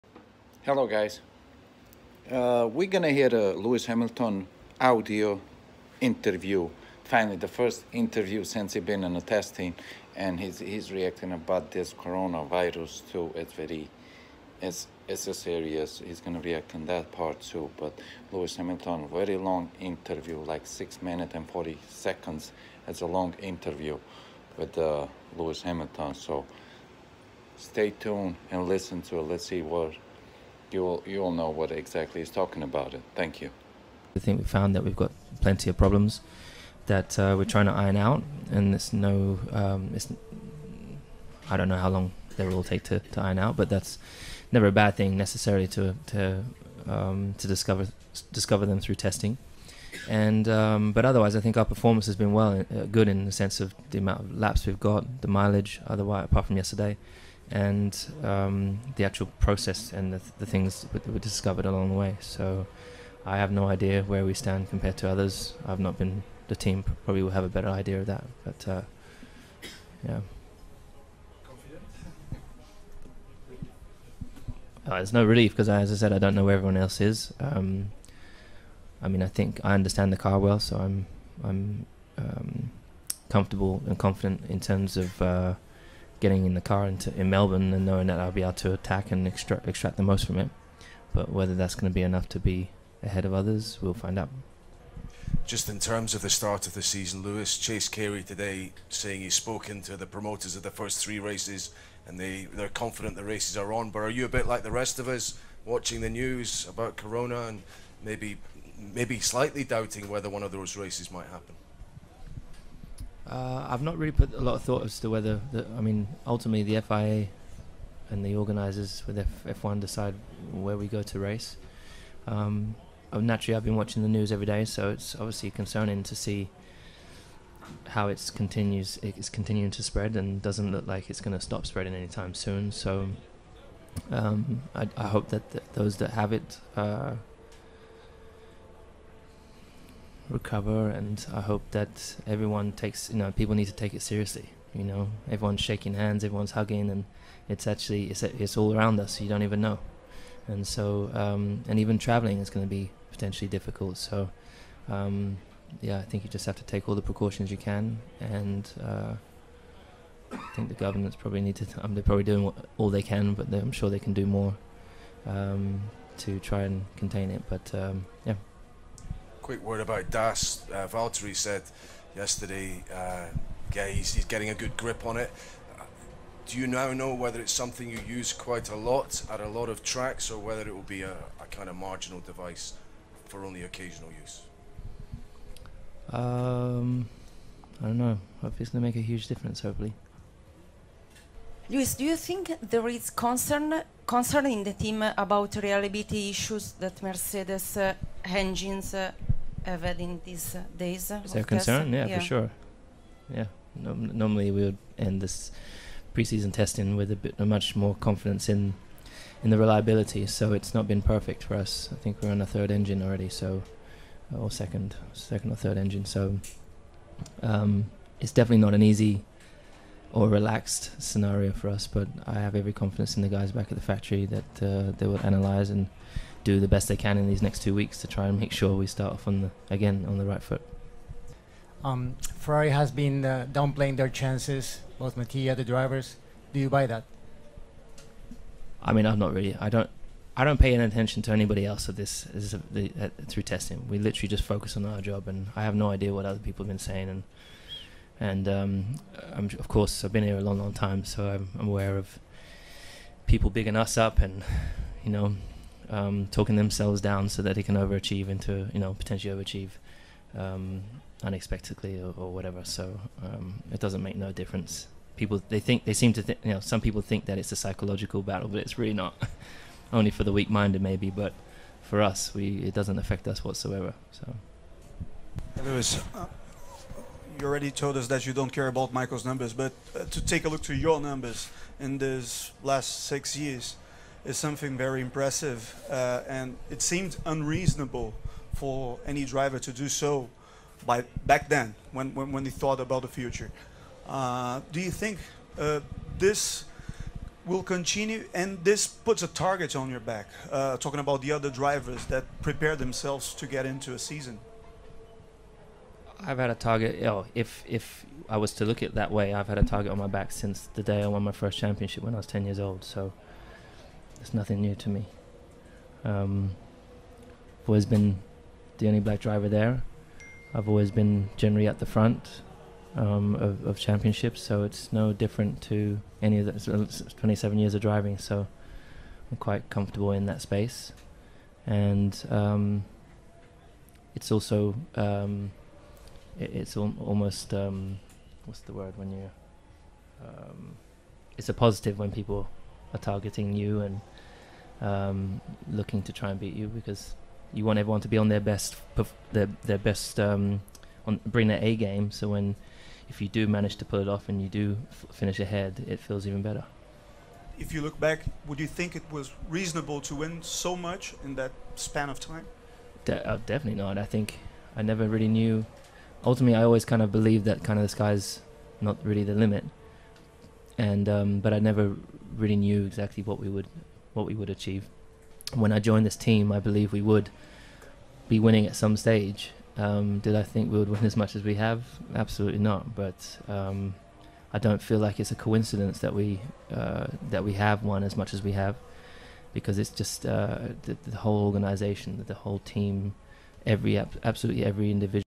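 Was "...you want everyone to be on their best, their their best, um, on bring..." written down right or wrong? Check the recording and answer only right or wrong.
right.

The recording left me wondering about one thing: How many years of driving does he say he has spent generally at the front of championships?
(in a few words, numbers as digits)
27.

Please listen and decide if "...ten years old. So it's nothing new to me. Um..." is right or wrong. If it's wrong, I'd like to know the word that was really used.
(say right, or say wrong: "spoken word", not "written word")
right.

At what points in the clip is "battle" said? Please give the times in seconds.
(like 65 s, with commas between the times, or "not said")
268 s.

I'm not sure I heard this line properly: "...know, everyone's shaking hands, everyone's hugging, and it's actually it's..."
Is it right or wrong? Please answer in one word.
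right.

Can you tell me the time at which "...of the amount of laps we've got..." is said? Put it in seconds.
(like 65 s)
53 s.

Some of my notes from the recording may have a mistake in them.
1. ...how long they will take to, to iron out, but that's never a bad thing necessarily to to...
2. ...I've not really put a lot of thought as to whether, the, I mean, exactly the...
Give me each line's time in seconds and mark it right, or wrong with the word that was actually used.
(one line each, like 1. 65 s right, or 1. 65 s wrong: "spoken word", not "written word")
1. 41 s right
2. 113 s wrong: "ultimately", not "exactly".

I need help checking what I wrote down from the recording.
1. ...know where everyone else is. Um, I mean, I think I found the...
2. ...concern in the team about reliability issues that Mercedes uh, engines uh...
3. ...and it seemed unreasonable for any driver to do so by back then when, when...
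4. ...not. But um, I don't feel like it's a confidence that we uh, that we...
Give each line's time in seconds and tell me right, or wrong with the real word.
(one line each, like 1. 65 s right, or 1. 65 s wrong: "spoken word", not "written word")
1. 76 s wrong: "understand", not "found"
2. 194 s right
3. 286 s right
4. 382 s wrong: "coincidence", not "confidence".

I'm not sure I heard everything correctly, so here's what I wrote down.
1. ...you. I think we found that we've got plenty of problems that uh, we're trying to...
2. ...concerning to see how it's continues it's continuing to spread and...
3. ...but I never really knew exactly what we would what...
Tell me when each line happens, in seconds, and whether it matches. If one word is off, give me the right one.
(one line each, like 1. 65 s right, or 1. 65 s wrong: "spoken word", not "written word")
1. 33 s right
2. 125 s right
3. 371 s right.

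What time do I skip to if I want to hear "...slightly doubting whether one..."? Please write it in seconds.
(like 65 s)
109 s.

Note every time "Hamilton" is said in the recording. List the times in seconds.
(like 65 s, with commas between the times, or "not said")
3 s, 18 s, 25 s.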